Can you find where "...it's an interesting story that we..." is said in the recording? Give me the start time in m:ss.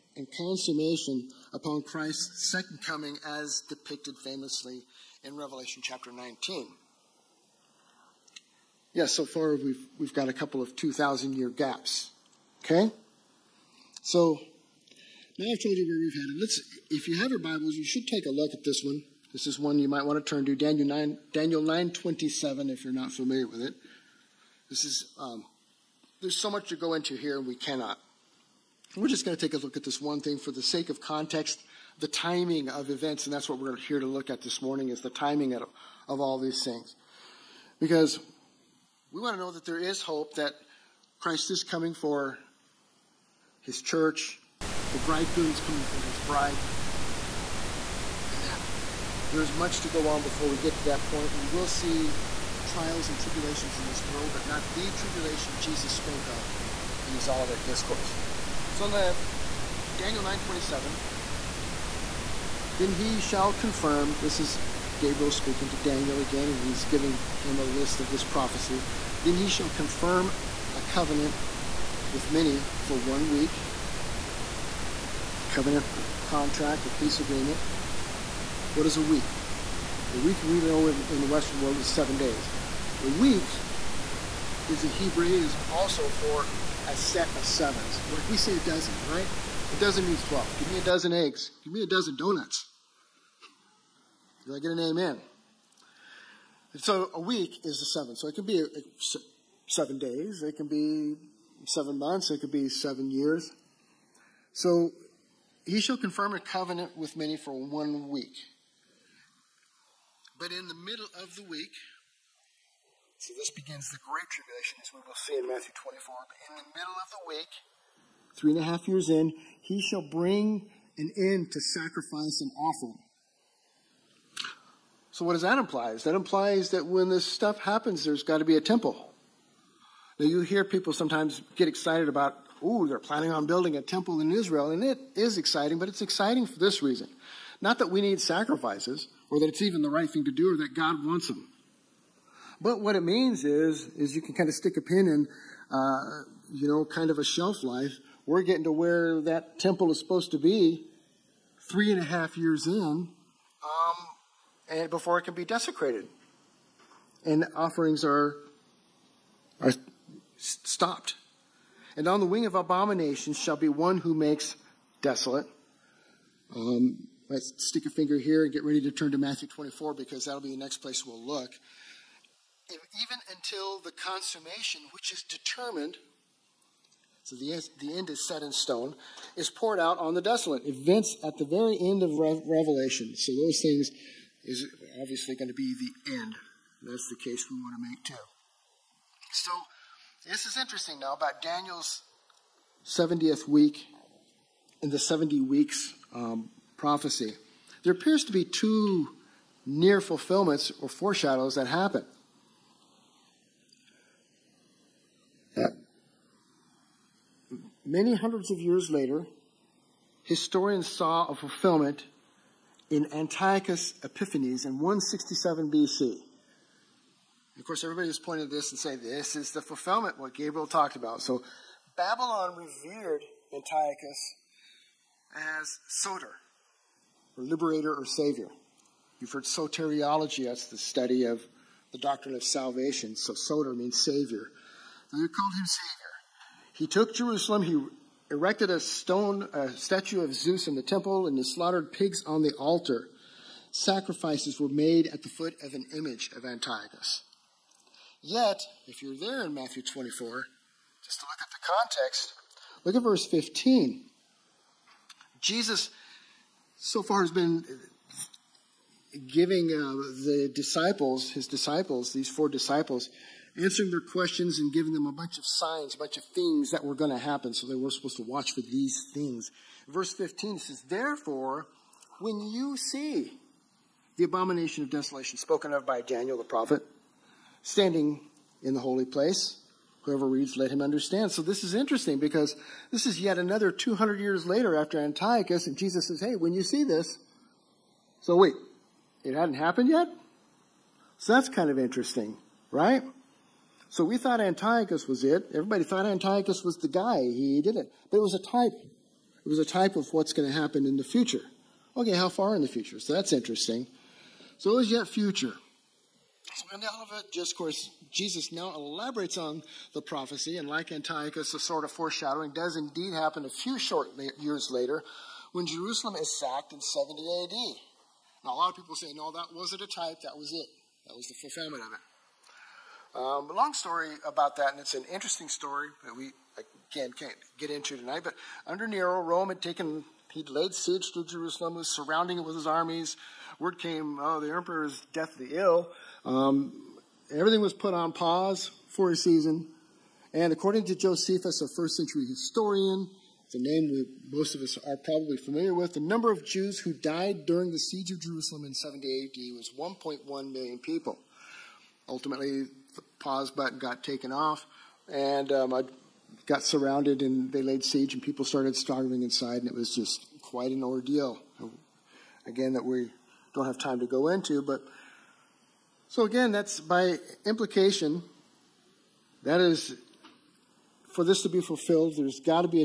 5:24.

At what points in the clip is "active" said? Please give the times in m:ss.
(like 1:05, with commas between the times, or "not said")
not said.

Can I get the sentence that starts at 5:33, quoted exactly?
Word came, oh, the emperor is deathly ill.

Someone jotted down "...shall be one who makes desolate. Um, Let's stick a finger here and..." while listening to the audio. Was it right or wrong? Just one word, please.
right.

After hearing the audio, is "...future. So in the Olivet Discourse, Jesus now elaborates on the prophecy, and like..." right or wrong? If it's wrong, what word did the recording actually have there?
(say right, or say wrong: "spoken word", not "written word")
right.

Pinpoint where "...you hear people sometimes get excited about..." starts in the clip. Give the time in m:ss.
2:10.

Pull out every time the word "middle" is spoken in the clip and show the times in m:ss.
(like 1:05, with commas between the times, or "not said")
1:50, 1:56.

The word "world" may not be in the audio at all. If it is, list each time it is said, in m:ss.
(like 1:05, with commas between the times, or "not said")
0:54, 1:21.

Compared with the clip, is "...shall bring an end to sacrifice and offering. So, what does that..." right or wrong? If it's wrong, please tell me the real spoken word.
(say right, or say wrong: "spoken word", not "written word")
right.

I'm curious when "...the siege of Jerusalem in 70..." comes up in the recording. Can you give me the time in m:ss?
5:47.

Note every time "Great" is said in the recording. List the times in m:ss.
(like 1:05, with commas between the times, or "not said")
1:53.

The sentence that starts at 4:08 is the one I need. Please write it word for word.
Yet, if you're there in Matthew 24, just to look at the context, look at verse 15.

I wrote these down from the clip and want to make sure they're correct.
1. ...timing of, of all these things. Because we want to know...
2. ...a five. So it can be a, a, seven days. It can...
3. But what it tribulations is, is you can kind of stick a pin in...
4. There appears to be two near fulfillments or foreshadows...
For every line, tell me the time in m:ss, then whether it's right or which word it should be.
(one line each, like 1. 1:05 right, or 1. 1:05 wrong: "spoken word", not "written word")
1. 0:35 right
2. 1:37 wrong: "seven", not "five"
3. 2:22 wrong: "means", not "tribulations"
4. 3:17 right.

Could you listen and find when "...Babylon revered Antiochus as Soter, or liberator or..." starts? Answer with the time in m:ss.
3:41.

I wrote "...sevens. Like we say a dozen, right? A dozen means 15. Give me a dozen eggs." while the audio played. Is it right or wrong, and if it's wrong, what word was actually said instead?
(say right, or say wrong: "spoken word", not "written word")
wrong: "12", not "15".